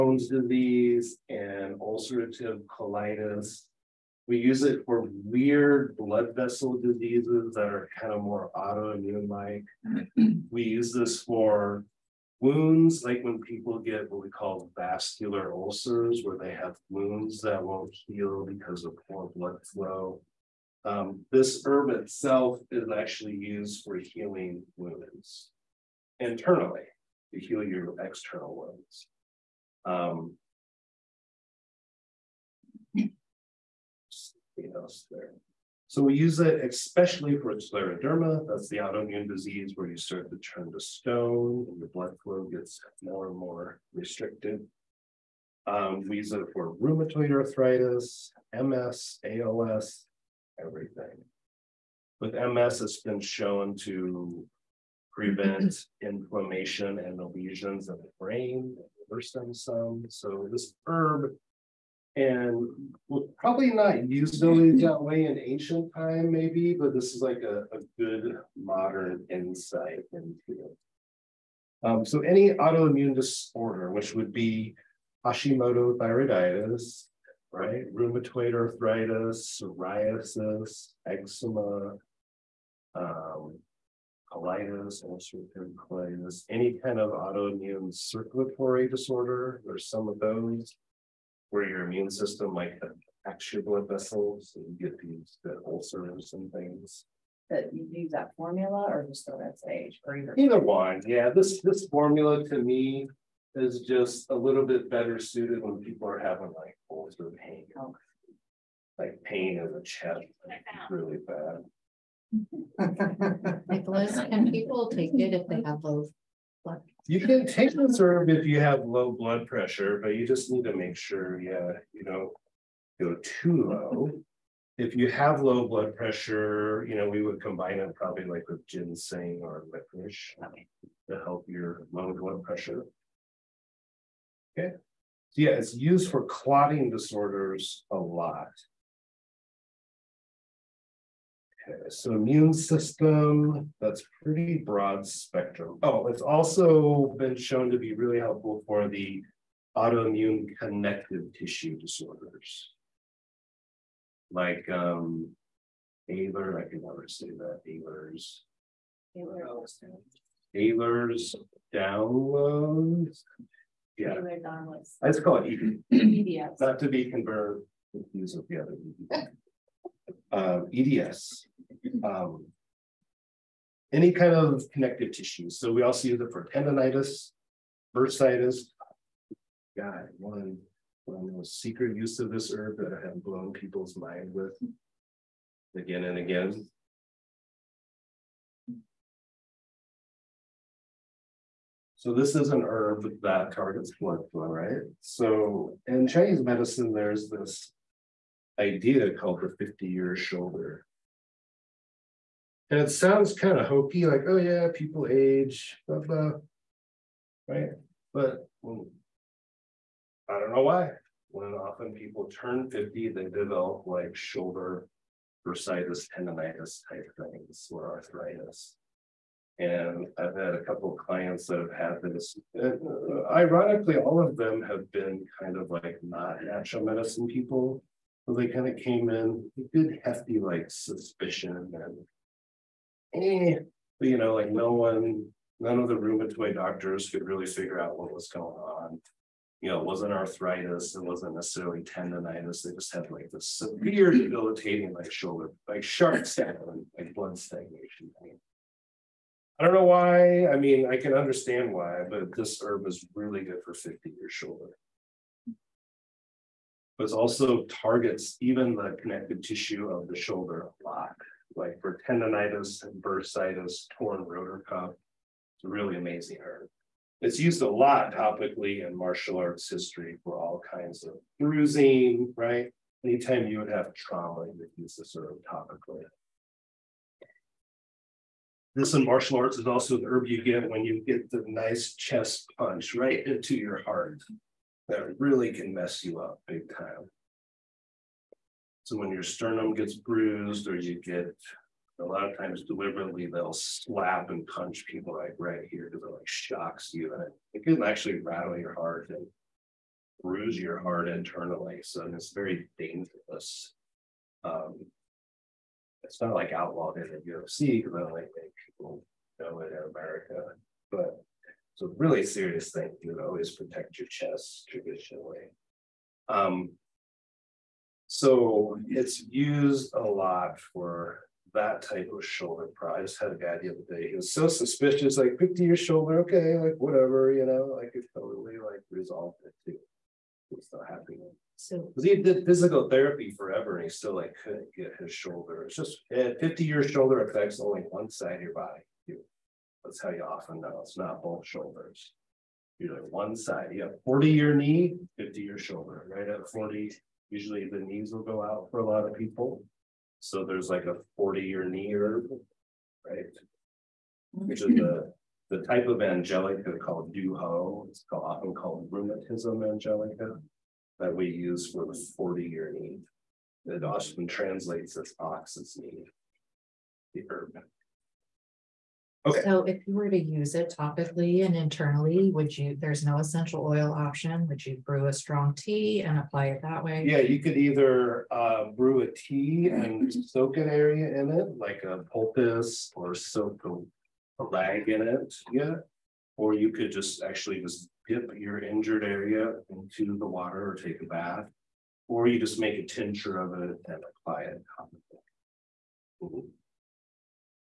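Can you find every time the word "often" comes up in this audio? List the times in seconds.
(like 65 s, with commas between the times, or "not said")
211 s, 340 s, 358 s, 363 s.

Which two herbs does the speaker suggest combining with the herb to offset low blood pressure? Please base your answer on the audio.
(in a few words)
Ginseng or licorice.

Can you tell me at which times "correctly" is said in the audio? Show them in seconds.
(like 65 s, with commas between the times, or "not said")
not said.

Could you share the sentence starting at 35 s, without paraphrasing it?
So we use it especially for scleroderma.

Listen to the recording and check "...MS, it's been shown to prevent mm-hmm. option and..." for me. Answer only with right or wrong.
wrong.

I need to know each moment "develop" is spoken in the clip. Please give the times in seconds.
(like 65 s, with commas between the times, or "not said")
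213 s.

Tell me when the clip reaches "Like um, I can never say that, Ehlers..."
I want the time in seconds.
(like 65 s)
154 s.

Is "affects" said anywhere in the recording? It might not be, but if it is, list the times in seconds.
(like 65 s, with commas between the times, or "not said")
337 s.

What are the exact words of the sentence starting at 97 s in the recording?
That you use that formula or just the red sage or either either one.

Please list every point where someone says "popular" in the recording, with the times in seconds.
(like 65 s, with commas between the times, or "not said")
not said.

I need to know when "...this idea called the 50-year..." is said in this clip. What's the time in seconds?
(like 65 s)
197 s.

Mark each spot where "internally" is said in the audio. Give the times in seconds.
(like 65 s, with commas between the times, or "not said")
26 s, 301 s, 371 s.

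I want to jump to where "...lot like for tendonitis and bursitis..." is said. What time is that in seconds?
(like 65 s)
260 s.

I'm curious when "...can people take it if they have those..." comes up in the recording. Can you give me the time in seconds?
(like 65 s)
114 s.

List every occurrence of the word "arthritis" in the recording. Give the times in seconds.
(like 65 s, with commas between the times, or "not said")
47 s, 78 s, 217 s, 240 s.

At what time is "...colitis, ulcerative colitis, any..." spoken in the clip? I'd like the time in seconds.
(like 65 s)
84 s.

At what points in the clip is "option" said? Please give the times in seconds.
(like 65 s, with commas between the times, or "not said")
373 s.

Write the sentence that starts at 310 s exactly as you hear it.
But it's a really serious thing.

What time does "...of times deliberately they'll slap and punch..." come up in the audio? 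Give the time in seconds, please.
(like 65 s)
292 s.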